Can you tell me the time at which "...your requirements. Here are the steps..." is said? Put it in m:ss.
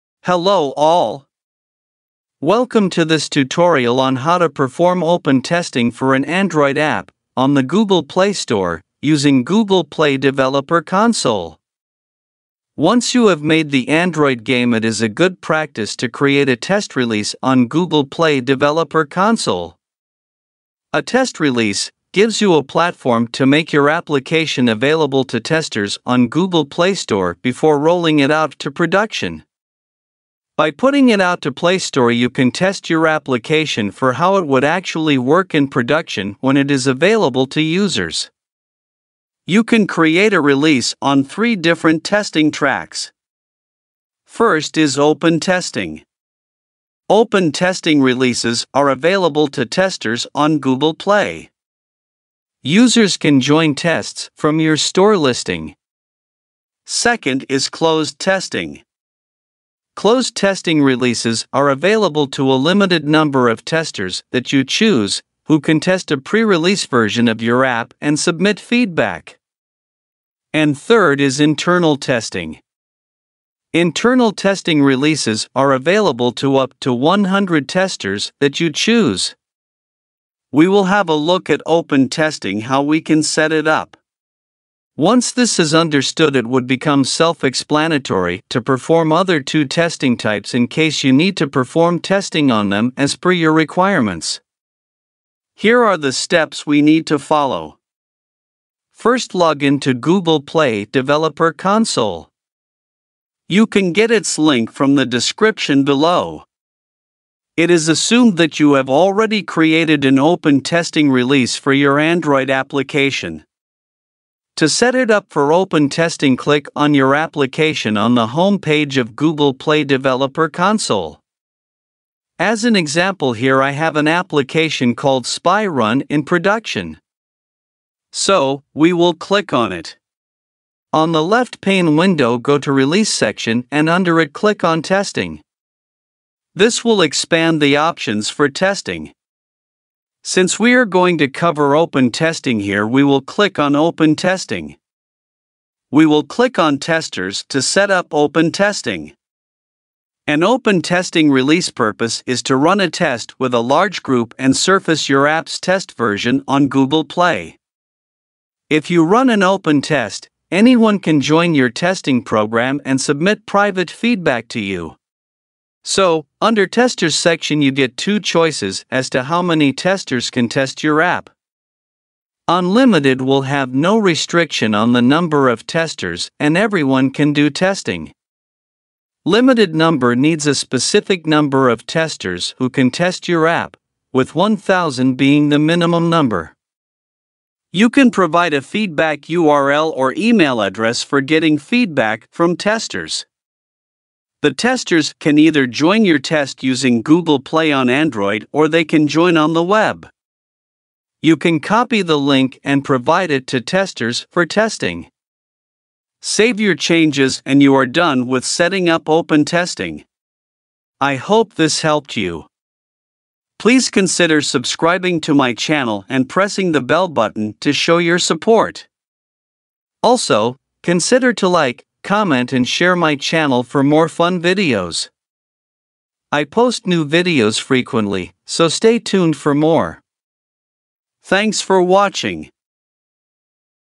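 1:33.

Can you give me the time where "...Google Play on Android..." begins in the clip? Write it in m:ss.
3:17.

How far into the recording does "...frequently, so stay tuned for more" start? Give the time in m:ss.
3:47.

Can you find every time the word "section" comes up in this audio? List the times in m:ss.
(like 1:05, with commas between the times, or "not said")
2:13, 2:47.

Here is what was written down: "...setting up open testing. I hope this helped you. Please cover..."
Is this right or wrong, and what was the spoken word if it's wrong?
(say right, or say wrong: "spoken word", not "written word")
wrong: "consider", not "cover".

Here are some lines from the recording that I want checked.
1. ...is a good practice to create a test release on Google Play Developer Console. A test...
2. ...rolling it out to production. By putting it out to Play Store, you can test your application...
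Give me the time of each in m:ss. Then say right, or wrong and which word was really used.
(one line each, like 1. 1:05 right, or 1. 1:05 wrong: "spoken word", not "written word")
1. 0:14 right
2. 0:27 right.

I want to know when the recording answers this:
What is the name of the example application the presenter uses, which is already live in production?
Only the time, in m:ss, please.
2:05.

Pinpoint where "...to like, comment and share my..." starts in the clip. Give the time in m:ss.
3:41.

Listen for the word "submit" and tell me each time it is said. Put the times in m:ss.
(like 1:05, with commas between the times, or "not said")
1:08, 2:43.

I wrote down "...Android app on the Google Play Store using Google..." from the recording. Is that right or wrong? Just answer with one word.
right.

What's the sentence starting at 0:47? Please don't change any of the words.
Open testing releases are available to testers on Google Play.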